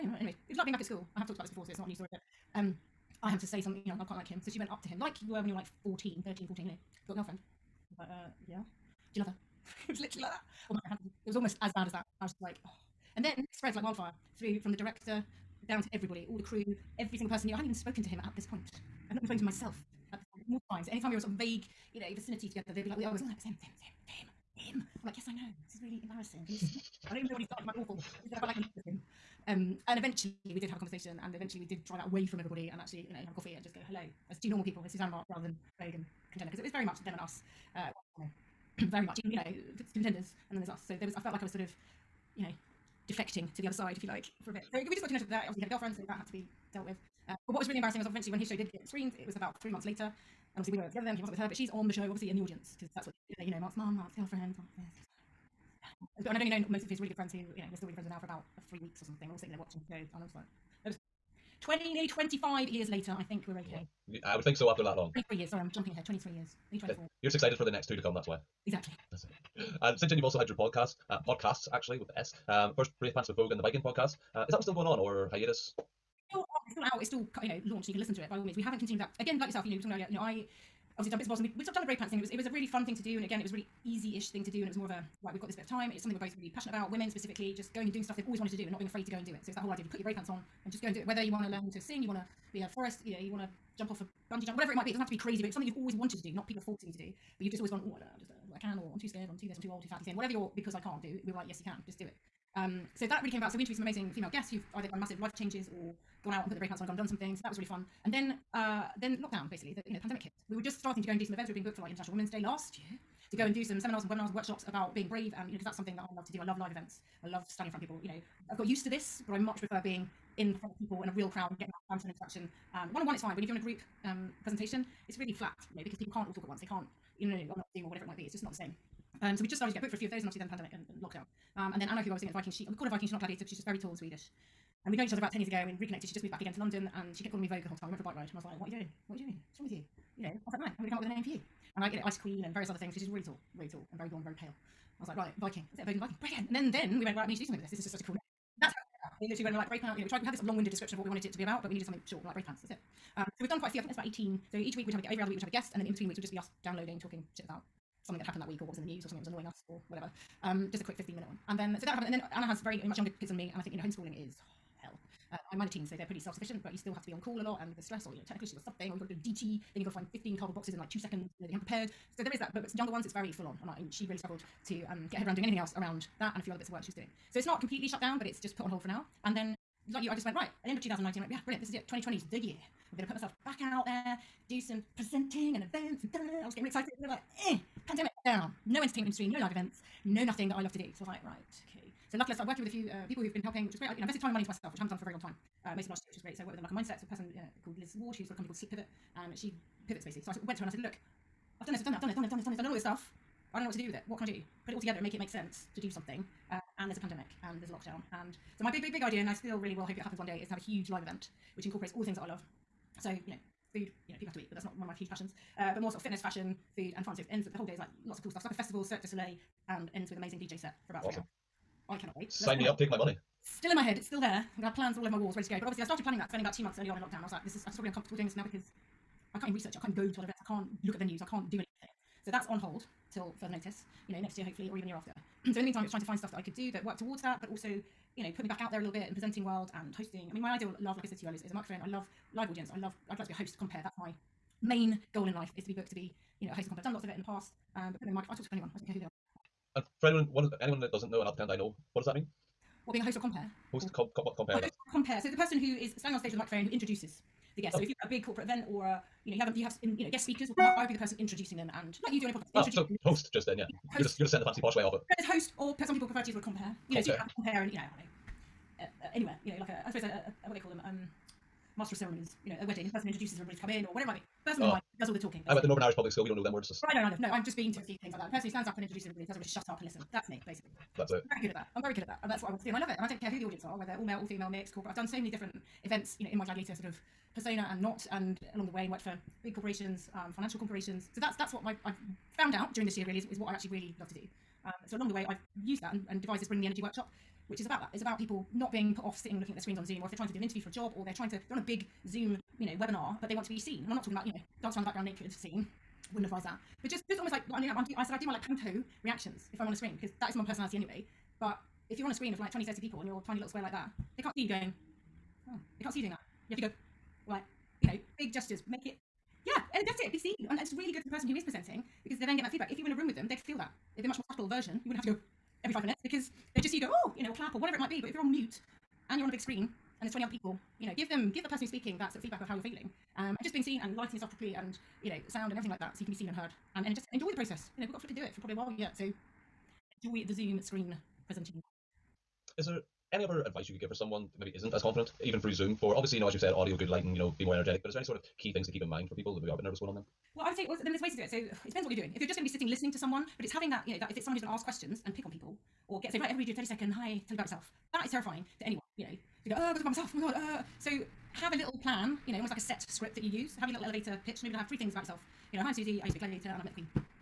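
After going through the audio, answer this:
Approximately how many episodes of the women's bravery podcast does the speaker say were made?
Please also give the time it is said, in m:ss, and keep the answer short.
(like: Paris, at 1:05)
18, at 2:33.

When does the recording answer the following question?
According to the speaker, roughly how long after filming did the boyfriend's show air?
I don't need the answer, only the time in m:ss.
0:49.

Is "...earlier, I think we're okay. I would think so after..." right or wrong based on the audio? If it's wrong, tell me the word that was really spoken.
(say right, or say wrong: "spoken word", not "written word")
wrong: "later", not "earlier".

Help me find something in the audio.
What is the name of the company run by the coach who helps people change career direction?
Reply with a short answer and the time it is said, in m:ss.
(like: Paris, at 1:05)
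Slip Pivot, at 3:18.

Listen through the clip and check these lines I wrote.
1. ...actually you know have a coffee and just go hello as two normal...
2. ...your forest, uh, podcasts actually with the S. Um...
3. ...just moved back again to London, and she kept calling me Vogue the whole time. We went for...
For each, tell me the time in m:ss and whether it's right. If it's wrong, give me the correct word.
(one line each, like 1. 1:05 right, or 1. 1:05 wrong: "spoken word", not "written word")
1. 0:32 right
2. 1:10 wrong: "podcast", not "forest"
3. 2:16 right.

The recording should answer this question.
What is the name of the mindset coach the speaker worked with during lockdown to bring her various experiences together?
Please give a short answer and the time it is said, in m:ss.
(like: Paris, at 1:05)
Liz Ward, at 3:17.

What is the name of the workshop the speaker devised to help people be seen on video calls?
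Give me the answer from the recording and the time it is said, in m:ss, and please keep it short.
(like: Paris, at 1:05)
Bring the Energy, at 4:56.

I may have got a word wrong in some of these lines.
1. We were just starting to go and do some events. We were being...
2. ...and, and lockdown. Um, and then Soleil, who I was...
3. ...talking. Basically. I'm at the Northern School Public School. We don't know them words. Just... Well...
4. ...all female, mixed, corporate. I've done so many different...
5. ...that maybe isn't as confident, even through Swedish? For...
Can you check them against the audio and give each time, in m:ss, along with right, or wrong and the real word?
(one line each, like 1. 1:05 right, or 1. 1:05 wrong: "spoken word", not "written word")
1. 1:50 right
2. 2:10 wrong: "Anna", not "Soleil"
3. 4:35 wrong: "Irish", not "School"
4. 4:44 right
5. 5:44 wrong: "Zoom", not "Swedish".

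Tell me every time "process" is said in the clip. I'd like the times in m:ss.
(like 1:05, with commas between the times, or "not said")
5:37.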